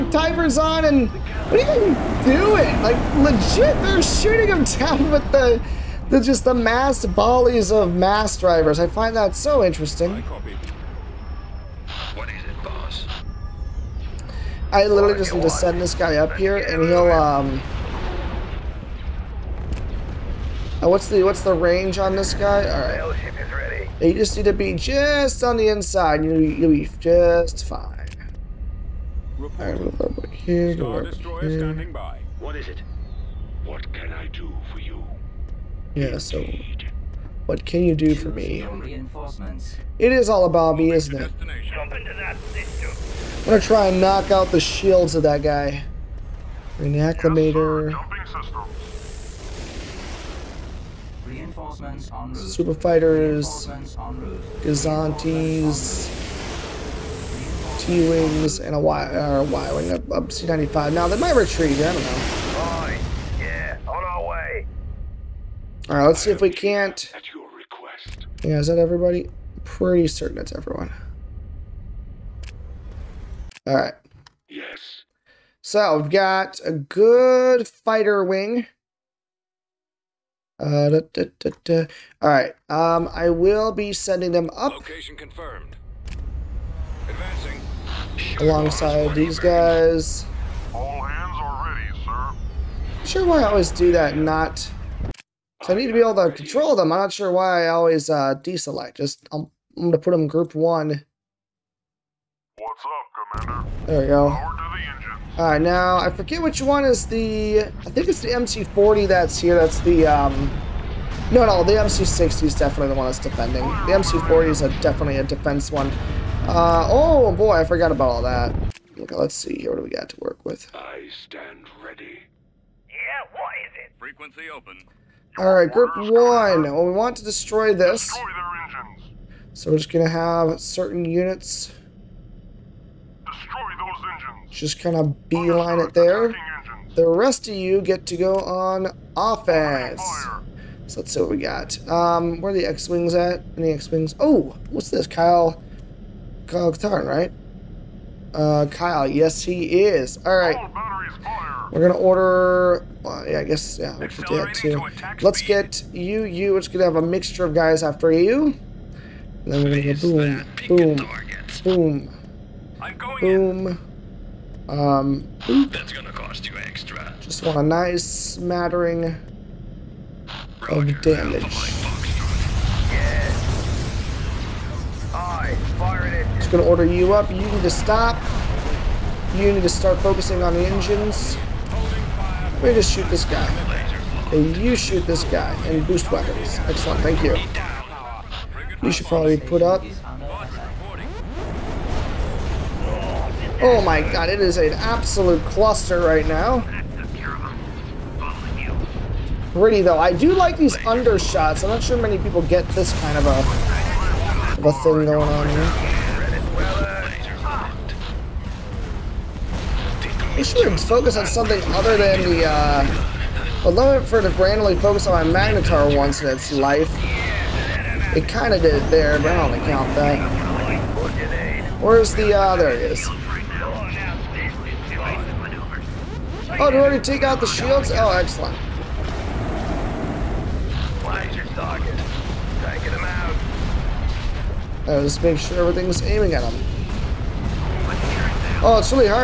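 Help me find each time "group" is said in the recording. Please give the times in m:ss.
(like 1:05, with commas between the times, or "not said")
1:40, 2:05.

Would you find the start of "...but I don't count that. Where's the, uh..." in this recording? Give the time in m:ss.
3:39.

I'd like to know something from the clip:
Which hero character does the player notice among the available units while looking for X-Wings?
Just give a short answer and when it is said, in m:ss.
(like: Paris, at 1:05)
Kyle Katarn, at 2:26.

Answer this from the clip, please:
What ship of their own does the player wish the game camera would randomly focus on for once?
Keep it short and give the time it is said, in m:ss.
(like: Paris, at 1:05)
Magnetar, at 3:35.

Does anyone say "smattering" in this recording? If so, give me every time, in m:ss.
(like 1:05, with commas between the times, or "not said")
2:48.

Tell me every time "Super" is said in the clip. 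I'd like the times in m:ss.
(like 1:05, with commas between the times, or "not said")
0:52.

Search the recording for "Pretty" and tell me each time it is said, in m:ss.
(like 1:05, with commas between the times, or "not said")
1:09, 3:19.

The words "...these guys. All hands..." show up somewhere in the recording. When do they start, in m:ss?
1:29.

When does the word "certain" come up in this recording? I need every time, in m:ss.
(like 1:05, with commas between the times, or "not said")
1:10, 2:10.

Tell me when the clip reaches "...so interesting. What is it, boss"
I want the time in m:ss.
0:09.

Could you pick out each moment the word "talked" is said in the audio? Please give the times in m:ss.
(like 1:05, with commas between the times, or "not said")
not said.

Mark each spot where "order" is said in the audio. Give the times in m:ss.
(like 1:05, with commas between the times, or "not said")
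2:31, 2:56.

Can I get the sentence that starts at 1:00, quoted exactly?
Now, they might retreat, I don't know.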